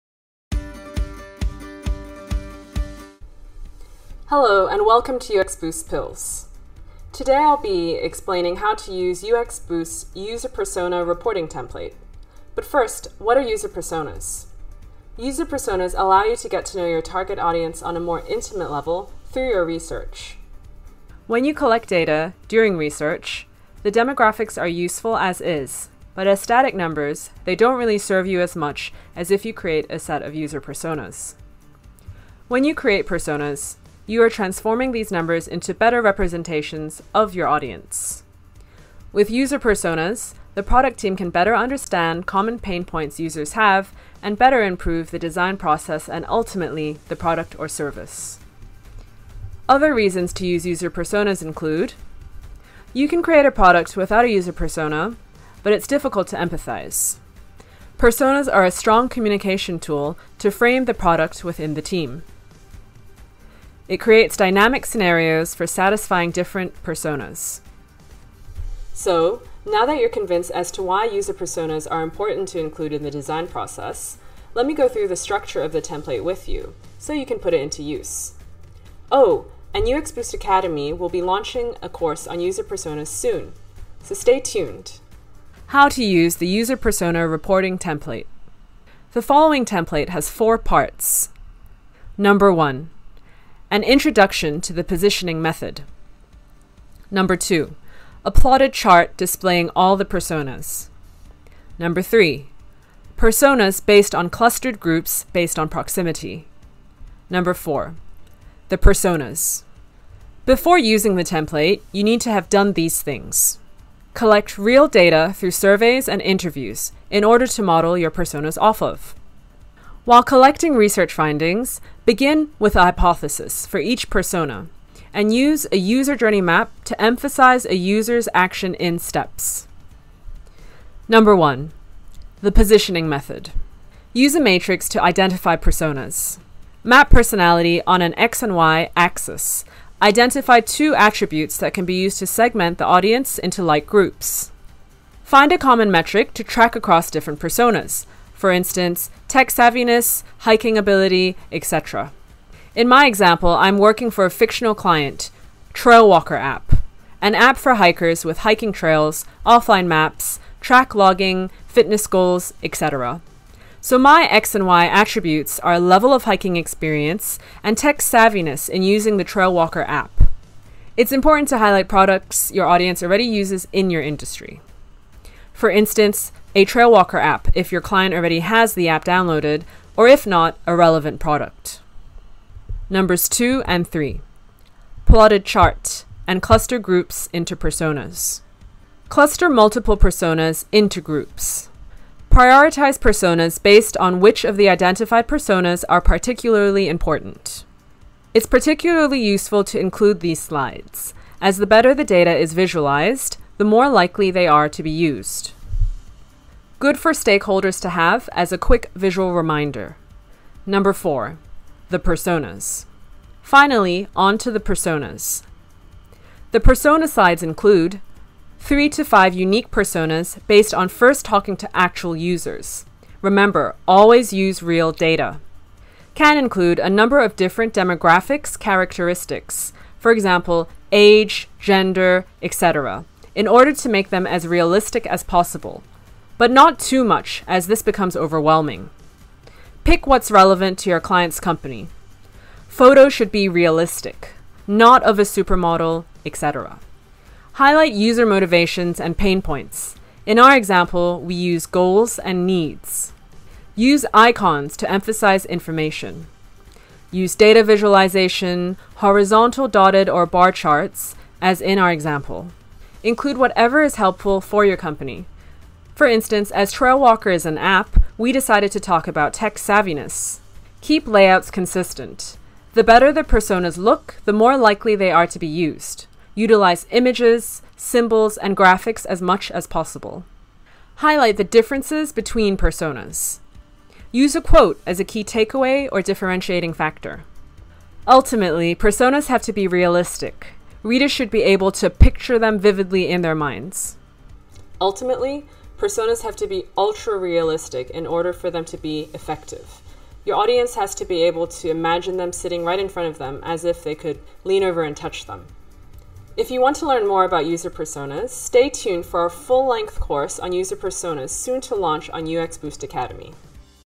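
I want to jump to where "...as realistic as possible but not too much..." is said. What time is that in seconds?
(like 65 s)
234 s.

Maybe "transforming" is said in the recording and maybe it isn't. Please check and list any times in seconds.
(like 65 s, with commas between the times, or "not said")
34 s.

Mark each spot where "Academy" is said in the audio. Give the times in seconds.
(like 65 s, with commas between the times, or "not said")
80 s, 312 s.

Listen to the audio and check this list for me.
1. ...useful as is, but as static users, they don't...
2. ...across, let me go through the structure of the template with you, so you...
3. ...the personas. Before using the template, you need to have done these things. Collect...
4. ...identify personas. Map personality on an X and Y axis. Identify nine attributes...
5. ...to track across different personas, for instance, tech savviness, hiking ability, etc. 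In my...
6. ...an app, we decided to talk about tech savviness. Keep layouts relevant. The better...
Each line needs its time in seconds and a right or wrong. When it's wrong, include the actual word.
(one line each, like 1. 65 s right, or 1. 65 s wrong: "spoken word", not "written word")
1. 24 s wrong: "numbers", not "users"
2. 73 s wrong: "process", not "across"
3. 108 s right
4. 135 s wrong: "two", not "nine"
5. 146 s right
6. 267 s wrong: "consistent", not "relevant".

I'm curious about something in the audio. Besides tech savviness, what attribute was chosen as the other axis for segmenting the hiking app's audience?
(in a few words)
Level of hiking experience.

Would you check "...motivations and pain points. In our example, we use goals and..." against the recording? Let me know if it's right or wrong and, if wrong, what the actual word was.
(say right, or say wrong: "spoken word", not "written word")
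right.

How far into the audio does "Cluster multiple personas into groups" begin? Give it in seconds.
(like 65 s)
189 s.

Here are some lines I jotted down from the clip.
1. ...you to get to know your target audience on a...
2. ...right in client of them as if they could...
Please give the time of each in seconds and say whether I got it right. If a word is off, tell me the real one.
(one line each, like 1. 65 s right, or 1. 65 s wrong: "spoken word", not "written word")
1. 16 s right
2. 302 s wrong: "front", not "client".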